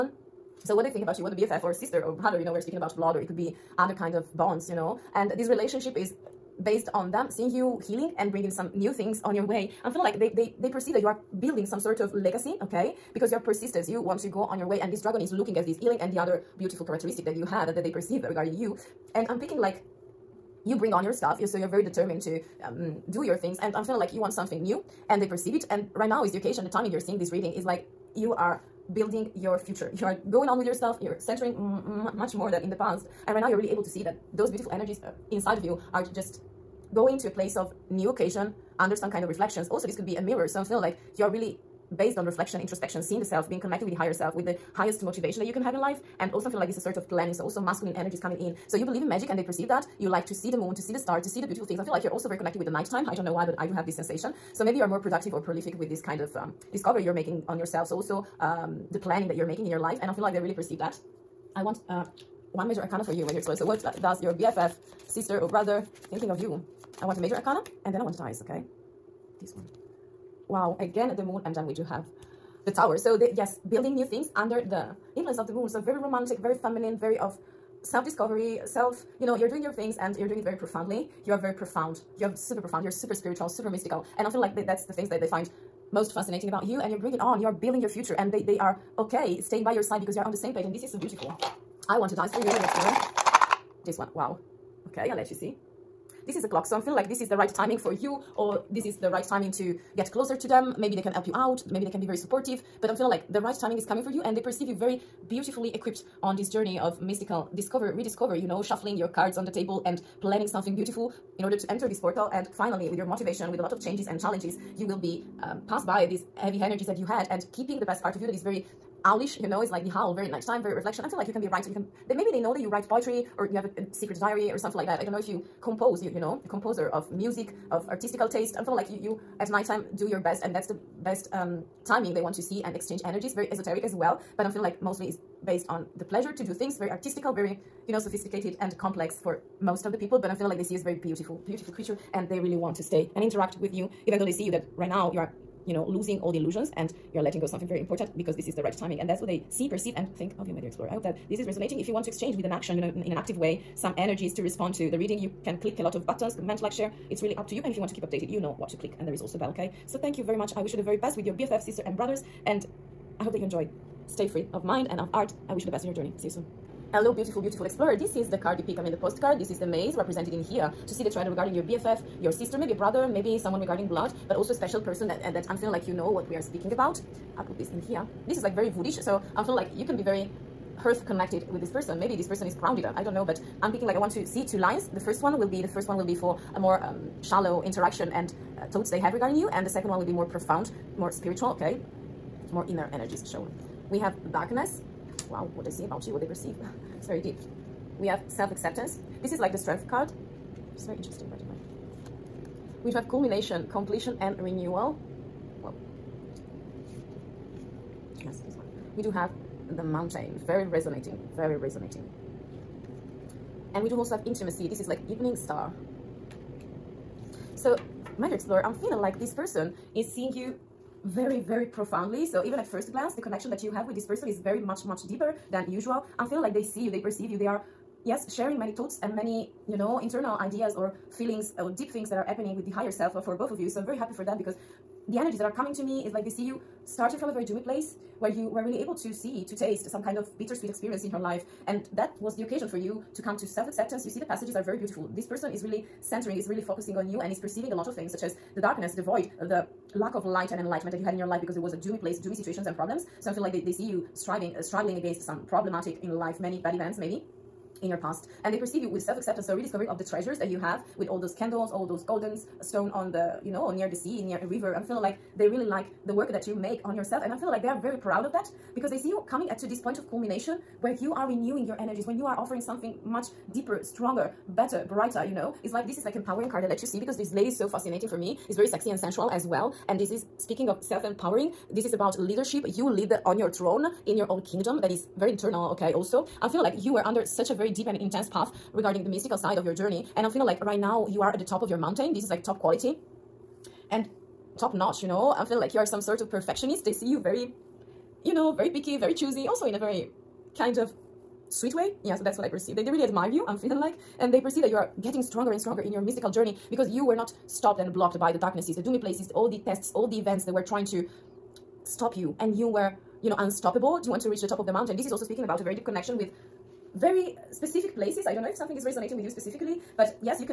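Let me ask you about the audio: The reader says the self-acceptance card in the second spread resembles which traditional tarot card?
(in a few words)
Strength.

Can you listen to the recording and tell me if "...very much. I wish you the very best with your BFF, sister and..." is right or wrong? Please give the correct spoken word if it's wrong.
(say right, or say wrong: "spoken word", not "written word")
right.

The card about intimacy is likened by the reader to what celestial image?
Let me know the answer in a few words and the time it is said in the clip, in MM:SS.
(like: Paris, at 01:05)
Evening star, at 03:35.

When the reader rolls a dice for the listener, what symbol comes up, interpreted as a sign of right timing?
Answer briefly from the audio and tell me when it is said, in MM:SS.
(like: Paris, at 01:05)
The clock, at 01:36.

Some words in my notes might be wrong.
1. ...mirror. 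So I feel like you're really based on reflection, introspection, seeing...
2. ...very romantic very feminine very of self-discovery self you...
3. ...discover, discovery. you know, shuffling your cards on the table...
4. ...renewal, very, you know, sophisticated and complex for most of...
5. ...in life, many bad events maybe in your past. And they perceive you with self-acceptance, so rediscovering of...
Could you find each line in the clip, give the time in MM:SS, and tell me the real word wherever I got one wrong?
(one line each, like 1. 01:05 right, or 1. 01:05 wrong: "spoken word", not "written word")
1. 00:40 right
2. 01:15 right
3. 01:47 wrong: "rediscovery", not "discovery"
4. 02:16 wrong: "artistical", not "renewal"
5. 04:16 right.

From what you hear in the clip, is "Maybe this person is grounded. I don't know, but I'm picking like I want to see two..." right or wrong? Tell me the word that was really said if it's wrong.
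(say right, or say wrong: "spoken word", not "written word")
right.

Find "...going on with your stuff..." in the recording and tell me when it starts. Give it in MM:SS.
00:30.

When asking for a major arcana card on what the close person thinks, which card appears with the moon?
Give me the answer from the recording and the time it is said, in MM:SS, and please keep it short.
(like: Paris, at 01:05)
The Tower, at 01:12.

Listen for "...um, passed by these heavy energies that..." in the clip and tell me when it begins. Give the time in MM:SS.
01:55.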